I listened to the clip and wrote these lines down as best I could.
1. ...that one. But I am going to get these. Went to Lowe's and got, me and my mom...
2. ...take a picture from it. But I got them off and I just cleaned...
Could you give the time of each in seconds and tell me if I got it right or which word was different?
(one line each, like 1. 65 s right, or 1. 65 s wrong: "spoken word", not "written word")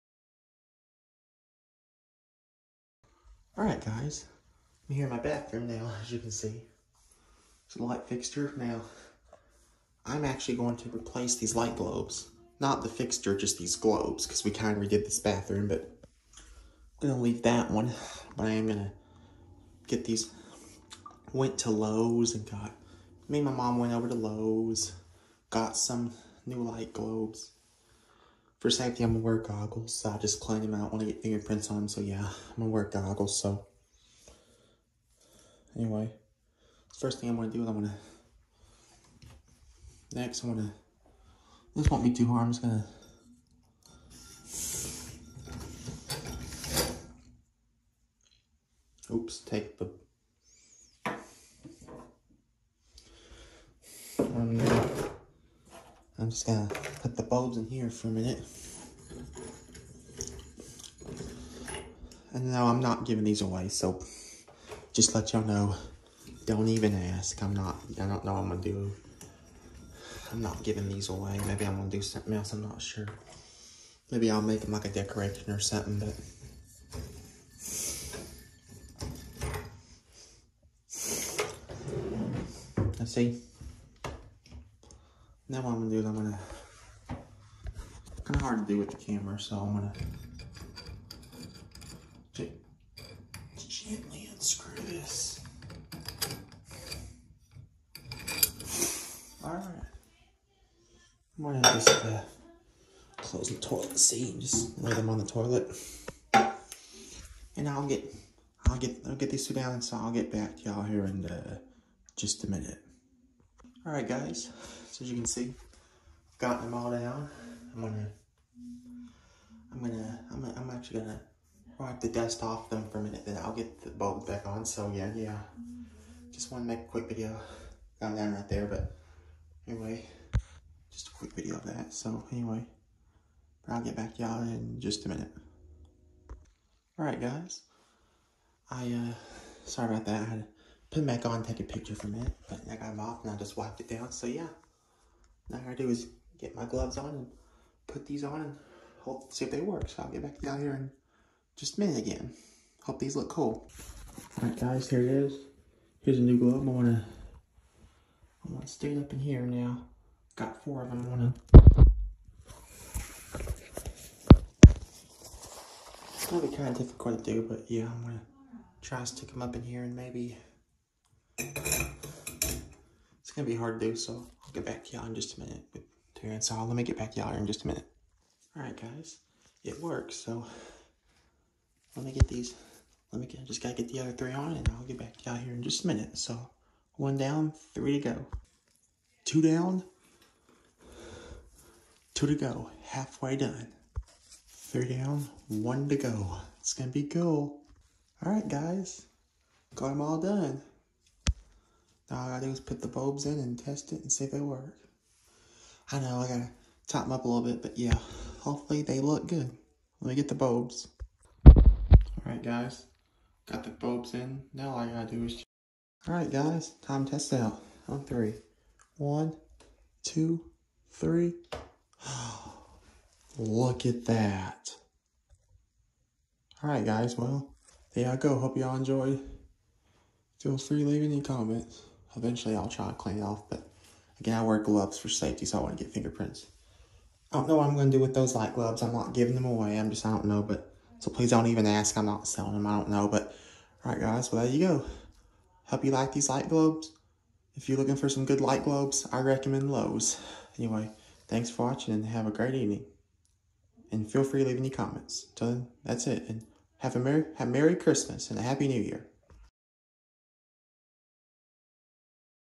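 1. 17 s right
2. 141 s wrong: "wiped", not "cleaned".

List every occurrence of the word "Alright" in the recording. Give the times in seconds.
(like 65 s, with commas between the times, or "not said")
3 s, 211 s, 216 s, 226 s.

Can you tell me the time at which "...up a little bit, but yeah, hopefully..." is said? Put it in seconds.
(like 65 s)
207 s.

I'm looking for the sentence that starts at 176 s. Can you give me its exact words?
Terrence, so let me get back y'all in just a minute.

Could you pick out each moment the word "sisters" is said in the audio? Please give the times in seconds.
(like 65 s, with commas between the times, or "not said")
not said.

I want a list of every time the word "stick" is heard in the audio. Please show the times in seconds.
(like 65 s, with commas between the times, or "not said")
158 s, 169 s.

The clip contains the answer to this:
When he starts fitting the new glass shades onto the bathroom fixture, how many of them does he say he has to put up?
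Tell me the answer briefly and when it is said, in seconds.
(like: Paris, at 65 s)
4, at 160 s.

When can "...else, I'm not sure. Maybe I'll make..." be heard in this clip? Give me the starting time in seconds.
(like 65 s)
72 s.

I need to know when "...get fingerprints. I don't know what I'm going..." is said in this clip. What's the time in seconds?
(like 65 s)
235 s.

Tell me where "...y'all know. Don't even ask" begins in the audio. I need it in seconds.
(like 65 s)
65 s.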